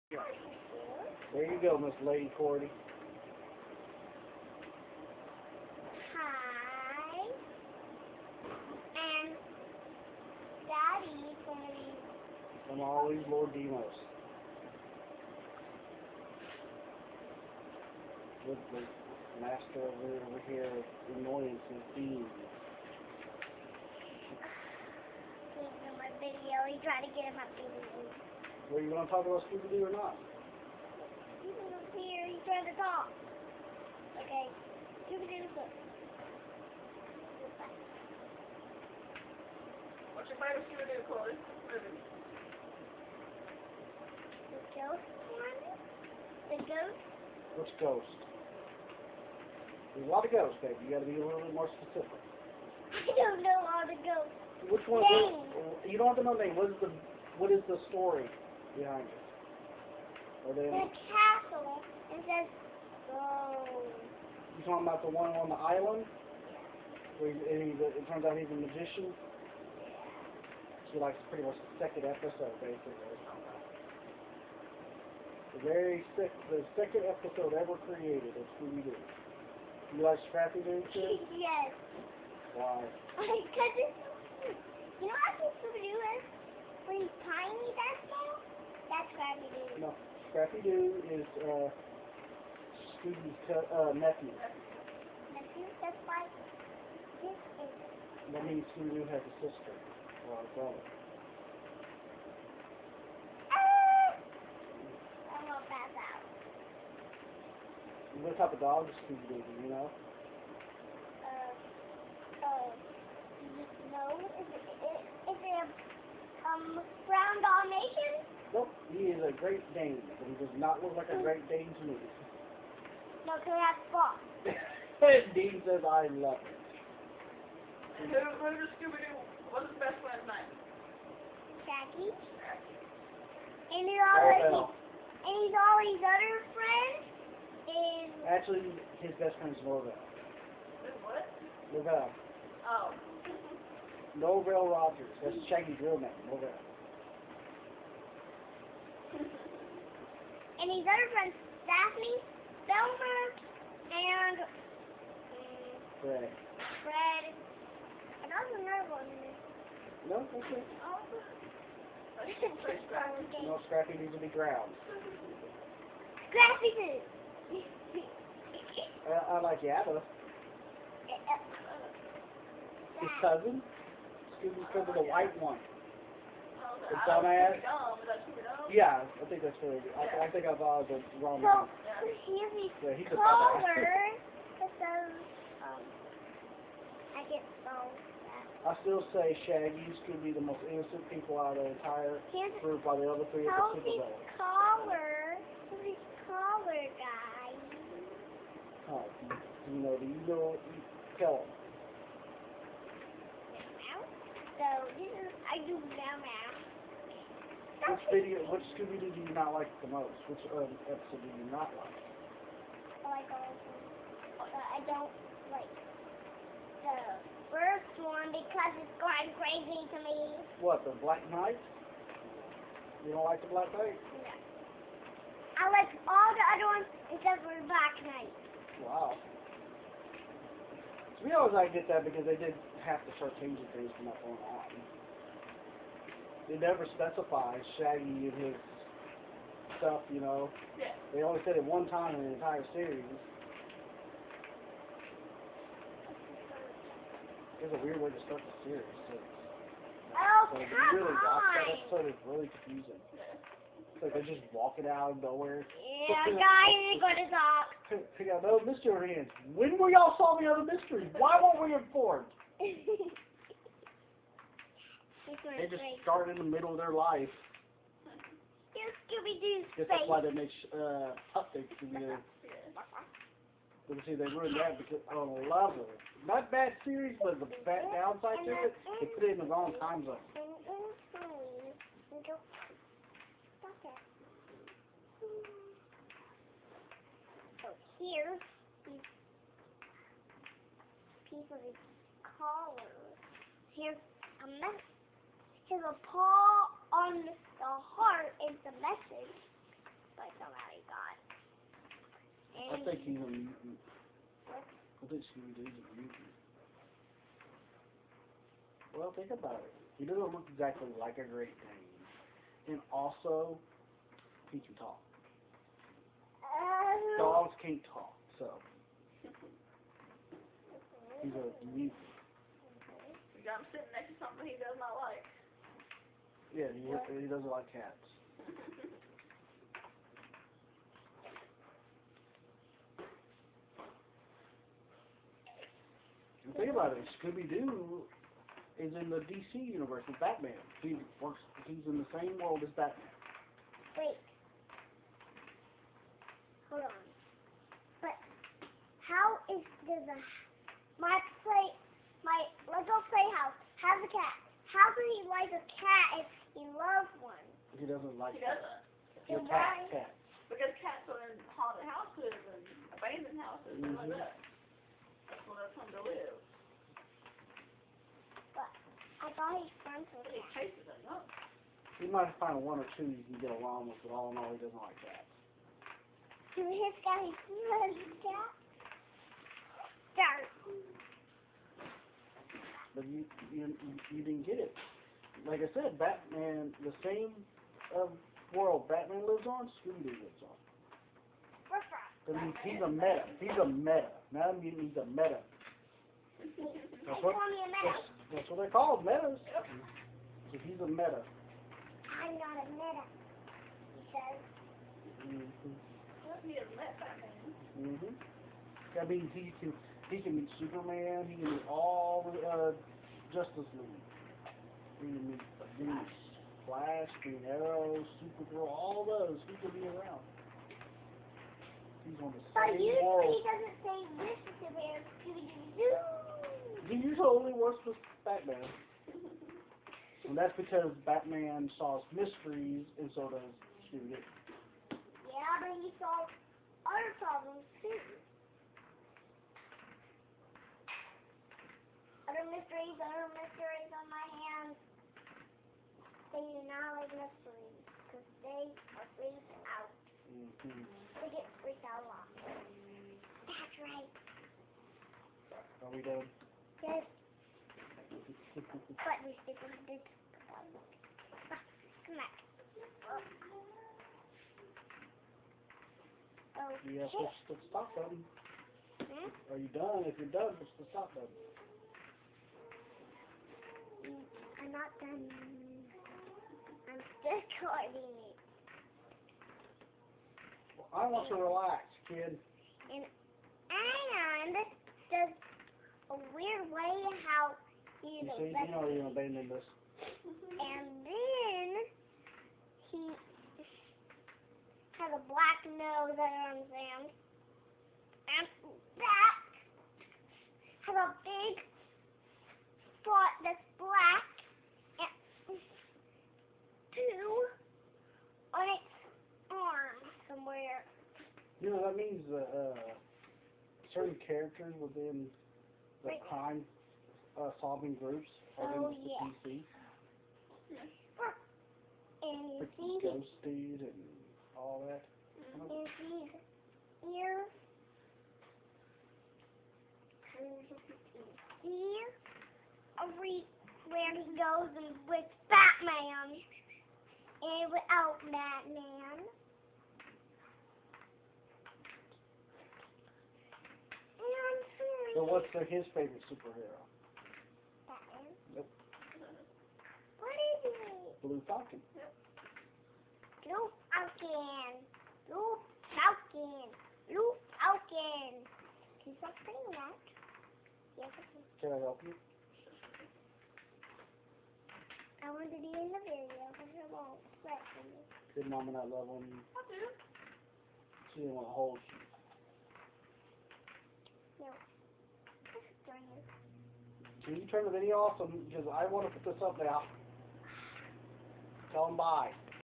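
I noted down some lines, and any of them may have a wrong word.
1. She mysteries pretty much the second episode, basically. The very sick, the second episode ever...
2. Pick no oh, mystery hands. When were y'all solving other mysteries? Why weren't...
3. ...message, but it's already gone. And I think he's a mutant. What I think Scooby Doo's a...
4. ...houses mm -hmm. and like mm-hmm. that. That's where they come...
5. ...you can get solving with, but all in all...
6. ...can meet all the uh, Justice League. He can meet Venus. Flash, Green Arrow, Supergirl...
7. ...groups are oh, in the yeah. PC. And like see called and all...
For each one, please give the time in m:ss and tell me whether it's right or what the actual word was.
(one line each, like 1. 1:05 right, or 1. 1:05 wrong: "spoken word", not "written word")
1. 1:10 wrong: "likes", not "mysteries"
2. 4:18 right
3. 4:58 right
4. 6:03 right
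5. 6:13 wrong: "along", not "solving"
6. 6:51 right
7. 8:37 wrong: "ghosted", not "called".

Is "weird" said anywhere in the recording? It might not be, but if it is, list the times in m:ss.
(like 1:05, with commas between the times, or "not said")
4:07, 8:06.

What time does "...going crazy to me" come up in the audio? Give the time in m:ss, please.
3:39.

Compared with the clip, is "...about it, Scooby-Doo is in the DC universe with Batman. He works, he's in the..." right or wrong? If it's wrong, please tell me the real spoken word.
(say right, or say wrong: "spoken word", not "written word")
right.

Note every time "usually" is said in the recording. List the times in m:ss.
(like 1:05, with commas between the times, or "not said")
7:02, 7:06.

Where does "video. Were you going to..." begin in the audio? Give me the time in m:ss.
0:27.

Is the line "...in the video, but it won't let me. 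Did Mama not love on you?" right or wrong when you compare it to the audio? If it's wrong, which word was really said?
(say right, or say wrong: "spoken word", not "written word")
right.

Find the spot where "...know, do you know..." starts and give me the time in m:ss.
3:19.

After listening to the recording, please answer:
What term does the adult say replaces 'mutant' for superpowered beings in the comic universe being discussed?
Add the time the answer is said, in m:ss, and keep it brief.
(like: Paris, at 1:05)
Metas, at 6:39.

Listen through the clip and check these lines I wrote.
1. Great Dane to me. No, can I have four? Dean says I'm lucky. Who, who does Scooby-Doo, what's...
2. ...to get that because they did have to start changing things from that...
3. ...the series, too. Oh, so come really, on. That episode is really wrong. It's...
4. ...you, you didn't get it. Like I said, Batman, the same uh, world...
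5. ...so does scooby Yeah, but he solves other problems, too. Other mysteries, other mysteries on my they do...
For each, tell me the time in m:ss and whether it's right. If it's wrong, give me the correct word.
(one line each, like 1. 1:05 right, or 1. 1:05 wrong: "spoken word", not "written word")
1. 2:01 right
2. 3:51 right
3. 4:08 wrong: "confusing", not "wrong"
4. 6:23 right
5. 7:13 right.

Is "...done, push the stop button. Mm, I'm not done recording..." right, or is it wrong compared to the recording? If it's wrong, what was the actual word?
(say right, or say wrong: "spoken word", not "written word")
right.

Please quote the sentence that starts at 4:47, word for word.
So here, piece of his collar.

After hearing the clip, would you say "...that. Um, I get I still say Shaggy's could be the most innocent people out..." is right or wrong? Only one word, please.
right.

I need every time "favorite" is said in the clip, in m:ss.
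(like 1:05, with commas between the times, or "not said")
0:40, 9:05.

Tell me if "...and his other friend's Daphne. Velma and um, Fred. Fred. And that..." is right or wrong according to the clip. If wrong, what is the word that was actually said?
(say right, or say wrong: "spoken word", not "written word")
right.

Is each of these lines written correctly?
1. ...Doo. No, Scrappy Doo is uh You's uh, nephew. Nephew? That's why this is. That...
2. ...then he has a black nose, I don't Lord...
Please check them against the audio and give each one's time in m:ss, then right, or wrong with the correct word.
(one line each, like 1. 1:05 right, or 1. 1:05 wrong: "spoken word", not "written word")
1. 1:29 wrong: "Phoebe", not "You"
2. 8:11 wrong: "And", not "Lord".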